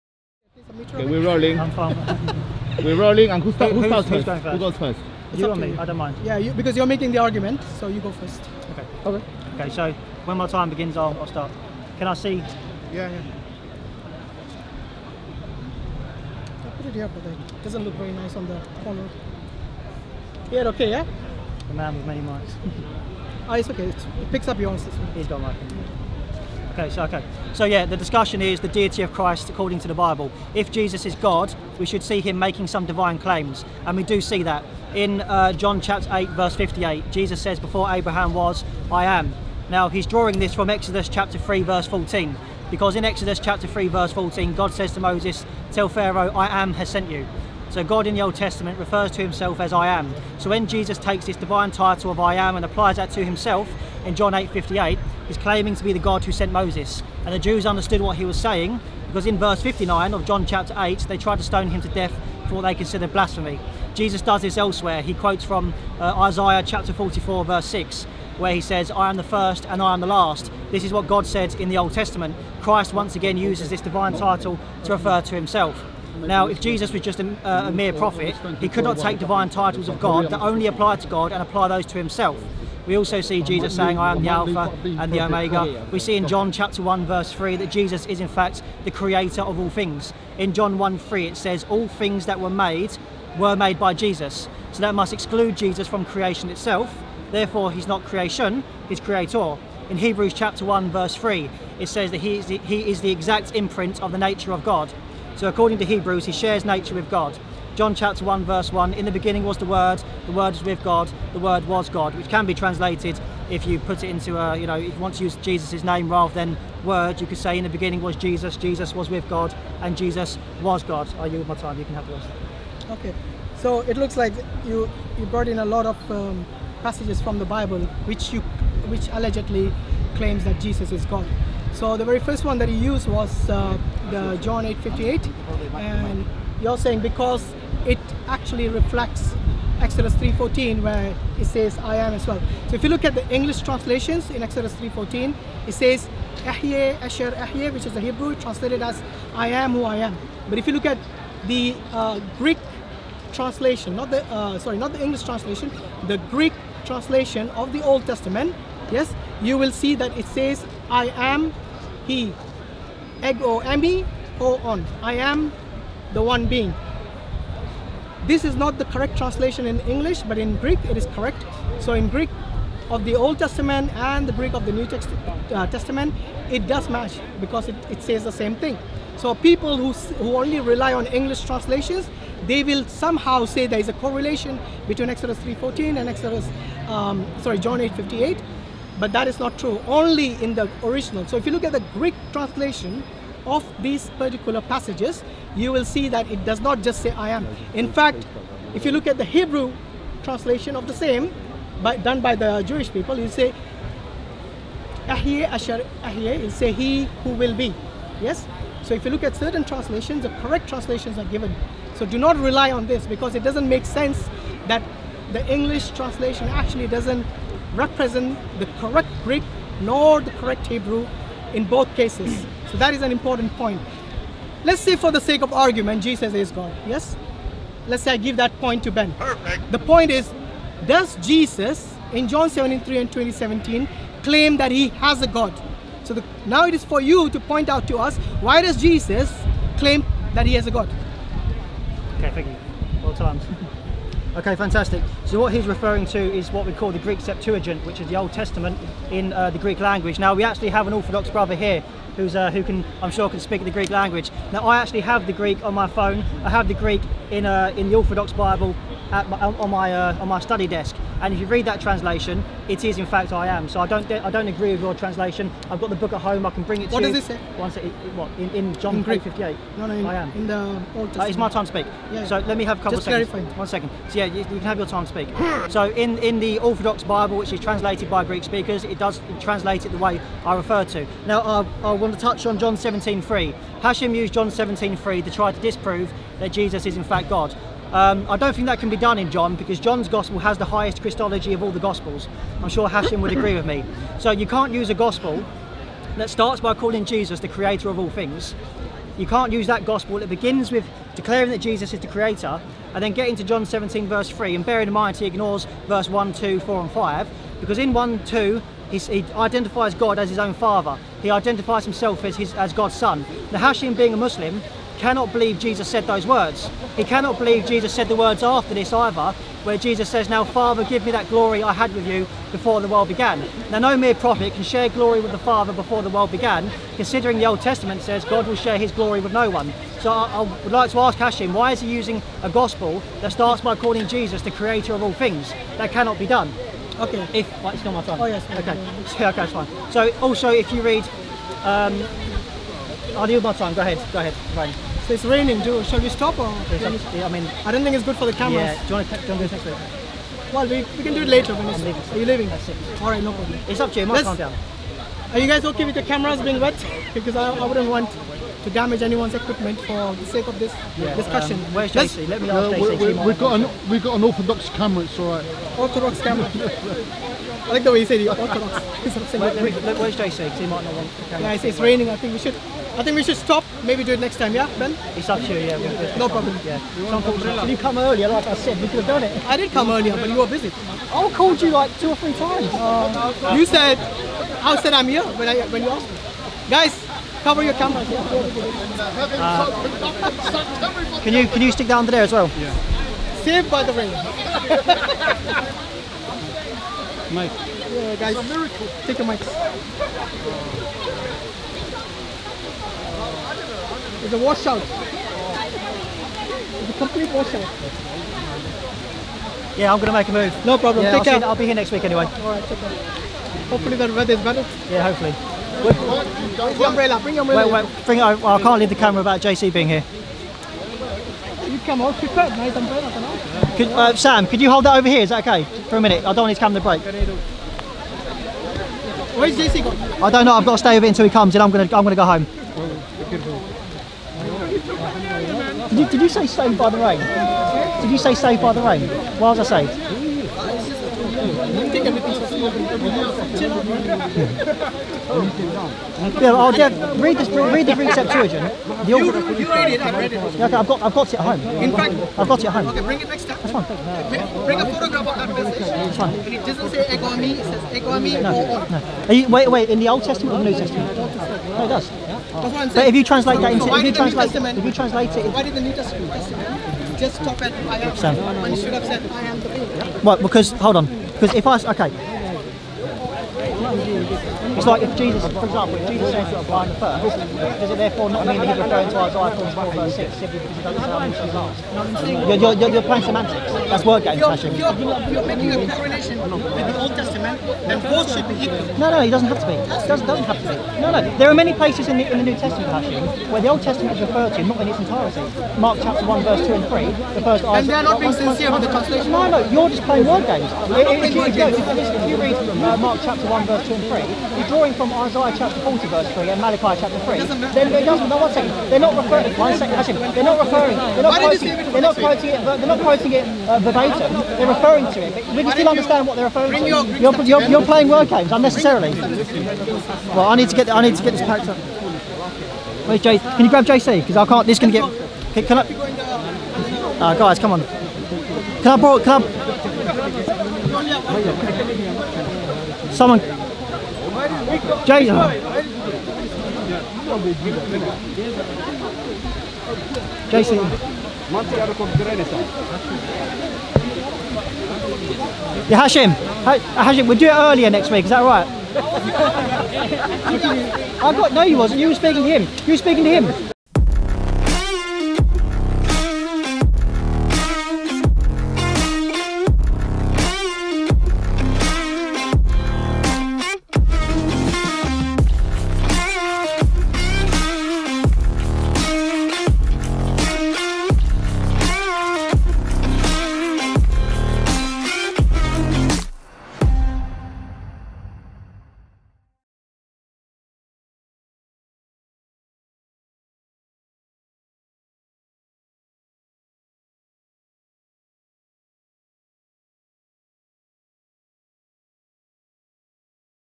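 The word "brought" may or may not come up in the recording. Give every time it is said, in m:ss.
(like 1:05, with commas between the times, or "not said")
2:05.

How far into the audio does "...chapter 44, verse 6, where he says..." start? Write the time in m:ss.
1:06.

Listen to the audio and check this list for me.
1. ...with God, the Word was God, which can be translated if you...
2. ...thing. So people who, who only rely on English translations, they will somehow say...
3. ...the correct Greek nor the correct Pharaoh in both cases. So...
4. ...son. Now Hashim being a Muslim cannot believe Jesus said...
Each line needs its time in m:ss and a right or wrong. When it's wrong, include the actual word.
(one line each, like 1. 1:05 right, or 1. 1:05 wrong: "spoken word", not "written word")
1. 1:50 right
2. 2:58 right
3. 3:38 wrong: "Hebrew", not "Pharaoh"
4. 5:12 right.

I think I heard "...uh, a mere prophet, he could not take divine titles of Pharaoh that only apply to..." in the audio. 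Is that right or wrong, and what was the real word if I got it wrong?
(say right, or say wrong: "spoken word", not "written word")
wrong: "God", not "Pharaoh".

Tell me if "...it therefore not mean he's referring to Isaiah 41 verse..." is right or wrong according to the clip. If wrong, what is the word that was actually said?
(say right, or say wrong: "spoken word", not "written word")
right.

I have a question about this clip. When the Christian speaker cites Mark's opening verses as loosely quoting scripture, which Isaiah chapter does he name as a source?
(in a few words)
Isaiah chapter 40.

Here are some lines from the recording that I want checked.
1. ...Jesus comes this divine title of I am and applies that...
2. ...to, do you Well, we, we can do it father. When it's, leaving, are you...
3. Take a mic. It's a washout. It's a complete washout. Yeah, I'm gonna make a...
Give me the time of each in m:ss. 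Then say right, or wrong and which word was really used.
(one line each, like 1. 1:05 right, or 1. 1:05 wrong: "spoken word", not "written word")
1. 0:50 wrong: "takes", not "comes"
2. 5:49 wrong: "later", not "father"
3. 6:39 right.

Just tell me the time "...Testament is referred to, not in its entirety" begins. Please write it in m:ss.
8:13.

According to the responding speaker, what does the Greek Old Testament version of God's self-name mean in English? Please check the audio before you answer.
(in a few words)
I am the one being.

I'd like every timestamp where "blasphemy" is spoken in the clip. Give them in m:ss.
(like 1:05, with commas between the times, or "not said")
1:03.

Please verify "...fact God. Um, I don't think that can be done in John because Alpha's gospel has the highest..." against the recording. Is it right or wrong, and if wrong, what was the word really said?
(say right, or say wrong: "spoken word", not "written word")
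wrong: "John", not "Alpha".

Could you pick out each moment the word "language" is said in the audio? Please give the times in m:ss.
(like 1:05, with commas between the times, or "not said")
4:09, 4:13.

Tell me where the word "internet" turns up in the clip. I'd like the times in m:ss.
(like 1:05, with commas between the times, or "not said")
not said.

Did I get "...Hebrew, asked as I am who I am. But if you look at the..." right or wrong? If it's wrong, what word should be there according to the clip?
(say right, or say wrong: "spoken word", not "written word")
wrong: "translated", not "asked".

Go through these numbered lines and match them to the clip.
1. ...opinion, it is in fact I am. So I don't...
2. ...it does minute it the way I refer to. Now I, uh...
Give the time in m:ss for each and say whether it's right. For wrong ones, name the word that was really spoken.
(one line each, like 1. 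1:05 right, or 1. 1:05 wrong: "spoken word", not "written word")
1. 4:21 wrong: "translation", not "opinion"
2. 4:38 wrong: "translate", not "minute".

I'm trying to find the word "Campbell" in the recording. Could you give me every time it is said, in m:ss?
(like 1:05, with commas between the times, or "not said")
not said.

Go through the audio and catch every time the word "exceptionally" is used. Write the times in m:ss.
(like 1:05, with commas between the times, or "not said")
not said.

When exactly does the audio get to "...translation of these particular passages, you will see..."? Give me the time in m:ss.
3:12.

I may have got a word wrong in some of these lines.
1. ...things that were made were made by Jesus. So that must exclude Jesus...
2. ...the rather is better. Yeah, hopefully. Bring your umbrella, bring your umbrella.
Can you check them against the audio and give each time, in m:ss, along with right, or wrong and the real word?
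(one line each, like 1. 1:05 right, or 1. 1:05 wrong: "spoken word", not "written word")
1. 1:31 right
2. 6:53 wrong: "weather", not "rather".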